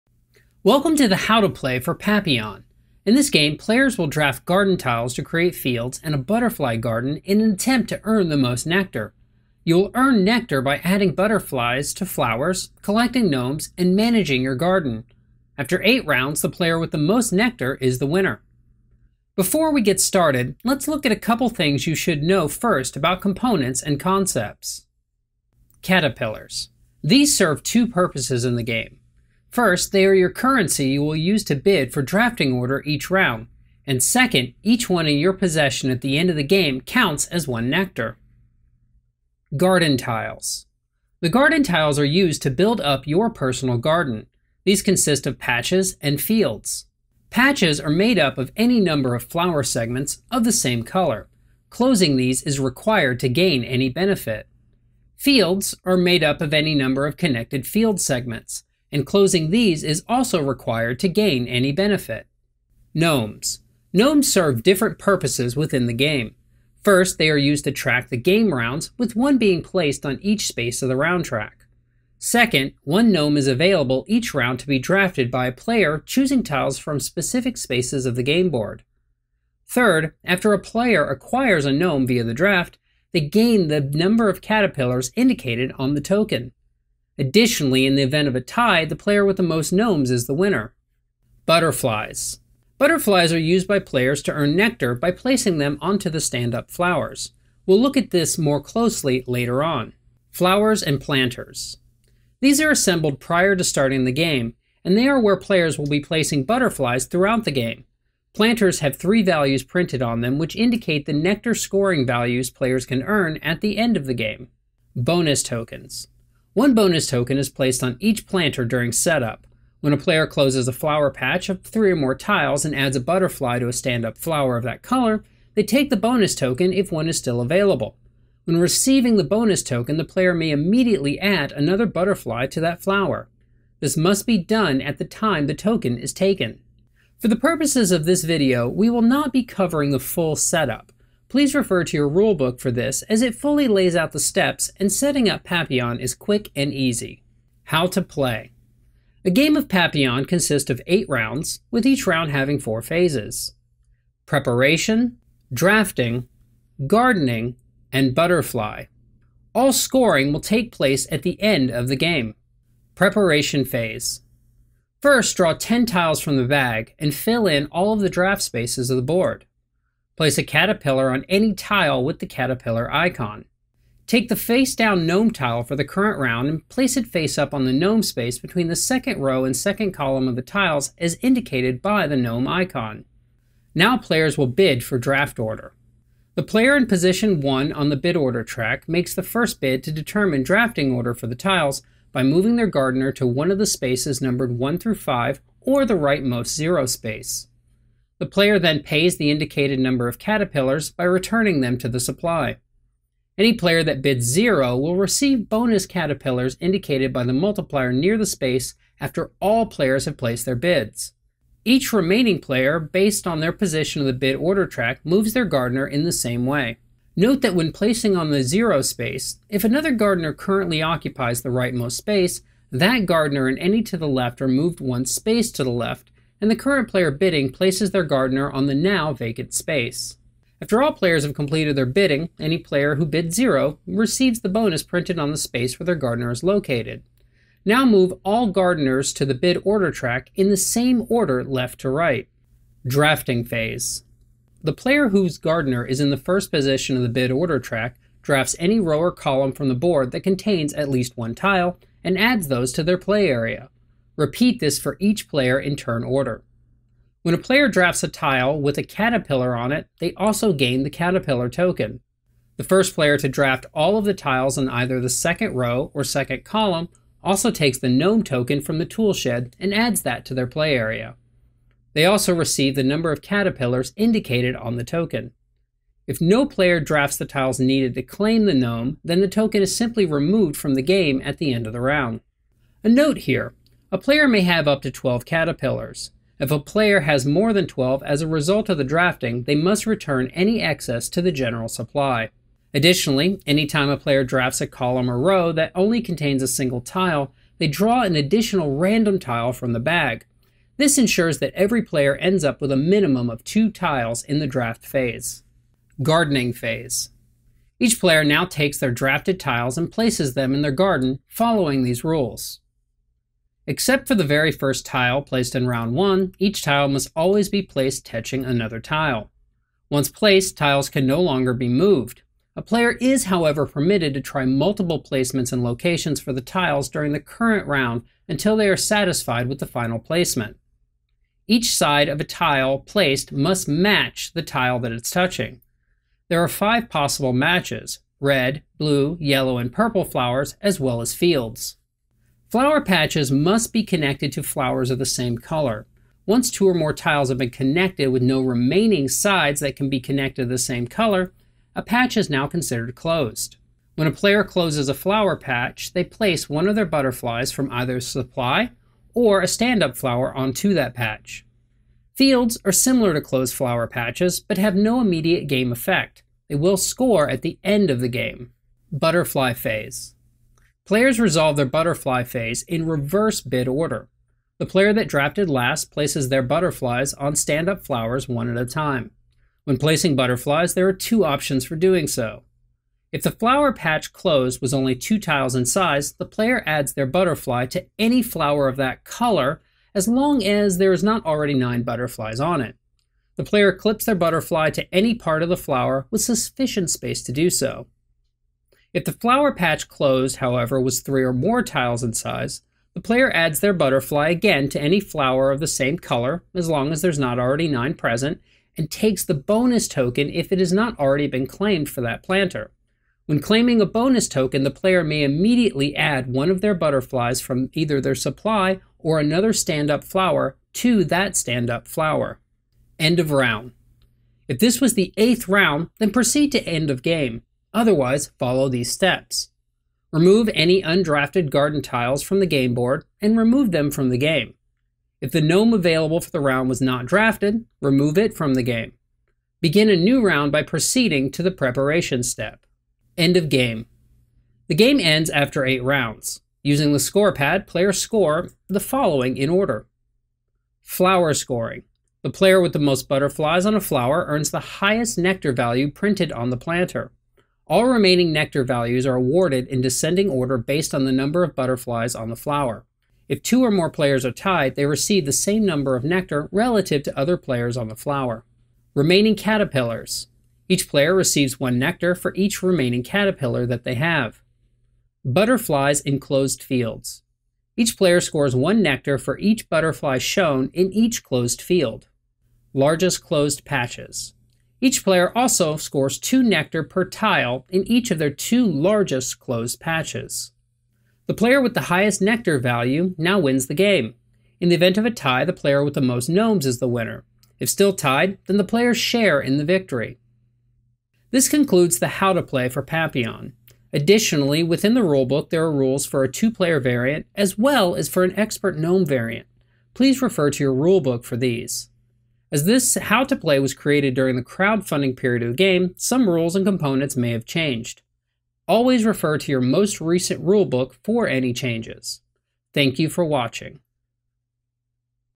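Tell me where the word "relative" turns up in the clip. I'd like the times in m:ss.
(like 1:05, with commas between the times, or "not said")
7:46.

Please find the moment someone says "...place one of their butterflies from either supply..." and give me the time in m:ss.
5:56.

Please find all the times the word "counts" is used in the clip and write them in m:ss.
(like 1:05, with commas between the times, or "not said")
0:36.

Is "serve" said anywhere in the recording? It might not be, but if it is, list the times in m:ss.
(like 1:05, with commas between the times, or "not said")
0:27, 1:04.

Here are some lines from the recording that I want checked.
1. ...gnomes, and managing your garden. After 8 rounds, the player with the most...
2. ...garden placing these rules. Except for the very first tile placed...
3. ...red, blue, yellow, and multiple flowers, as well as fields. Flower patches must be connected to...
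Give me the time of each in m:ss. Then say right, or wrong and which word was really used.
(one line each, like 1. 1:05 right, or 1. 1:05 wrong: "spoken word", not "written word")
1. 0:13 right
2. 5:10 wrong: "following", not "placing"
3. 5:38 wrong: "purple", not "multiple".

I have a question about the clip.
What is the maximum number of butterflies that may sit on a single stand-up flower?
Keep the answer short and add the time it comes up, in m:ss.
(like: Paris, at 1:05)
9, at 6:31.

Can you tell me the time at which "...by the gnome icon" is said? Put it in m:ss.
3:01.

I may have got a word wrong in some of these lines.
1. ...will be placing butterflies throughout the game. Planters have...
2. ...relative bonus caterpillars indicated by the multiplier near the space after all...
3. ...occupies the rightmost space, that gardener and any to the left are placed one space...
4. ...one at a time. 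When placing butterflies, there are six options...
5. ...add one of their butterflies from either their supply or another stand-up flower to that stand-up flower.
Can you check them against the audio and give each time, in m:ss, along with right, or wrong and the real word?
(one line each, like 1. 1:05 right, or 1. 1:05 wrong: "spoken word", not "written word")
1. 1:45 right
2. 3:24 wrong: "receive", not "relative"
3. 3:40 wrong: "moved", not "placed"
4. 6:18 wrong: "two", not "six"
5. 6:55 right.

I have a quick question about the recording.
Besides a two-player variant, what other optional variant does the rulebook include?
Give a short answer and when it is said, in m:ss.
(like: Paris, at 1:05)
Expert gnome variant, at 8:28.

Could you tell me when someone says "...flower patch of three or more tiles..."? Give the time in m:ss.
2:00.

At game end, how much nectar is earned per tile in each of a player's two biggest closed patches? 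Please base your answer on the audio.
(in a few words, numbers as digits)
2.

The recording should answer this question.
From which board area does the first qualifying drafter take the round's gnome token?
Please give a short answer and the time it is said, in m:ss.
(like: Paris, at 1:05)
Tool shed, at 4:28.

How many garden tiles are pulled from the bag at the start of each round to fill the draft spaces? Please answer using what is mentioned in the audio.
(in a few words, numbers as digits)
10.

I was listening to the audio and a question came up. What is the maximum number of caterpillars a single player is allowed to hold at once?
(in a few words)
12.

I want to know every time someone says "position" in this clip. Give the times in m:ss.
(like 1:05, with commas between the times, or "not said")
3:06, 3:33, 4:06.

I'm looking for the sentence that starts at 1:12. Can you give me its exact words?
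Second, one gnome is available each round to be drafted by a player choosing tiles from specific spaces of the game board.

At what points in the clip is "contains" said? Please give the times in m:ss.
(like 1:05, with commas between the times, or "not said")
4:10, 4:55.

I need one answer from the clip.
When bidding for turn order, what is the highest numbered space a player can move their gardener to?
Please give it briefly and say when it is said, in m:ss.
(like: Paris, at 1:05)
5, at 3:14.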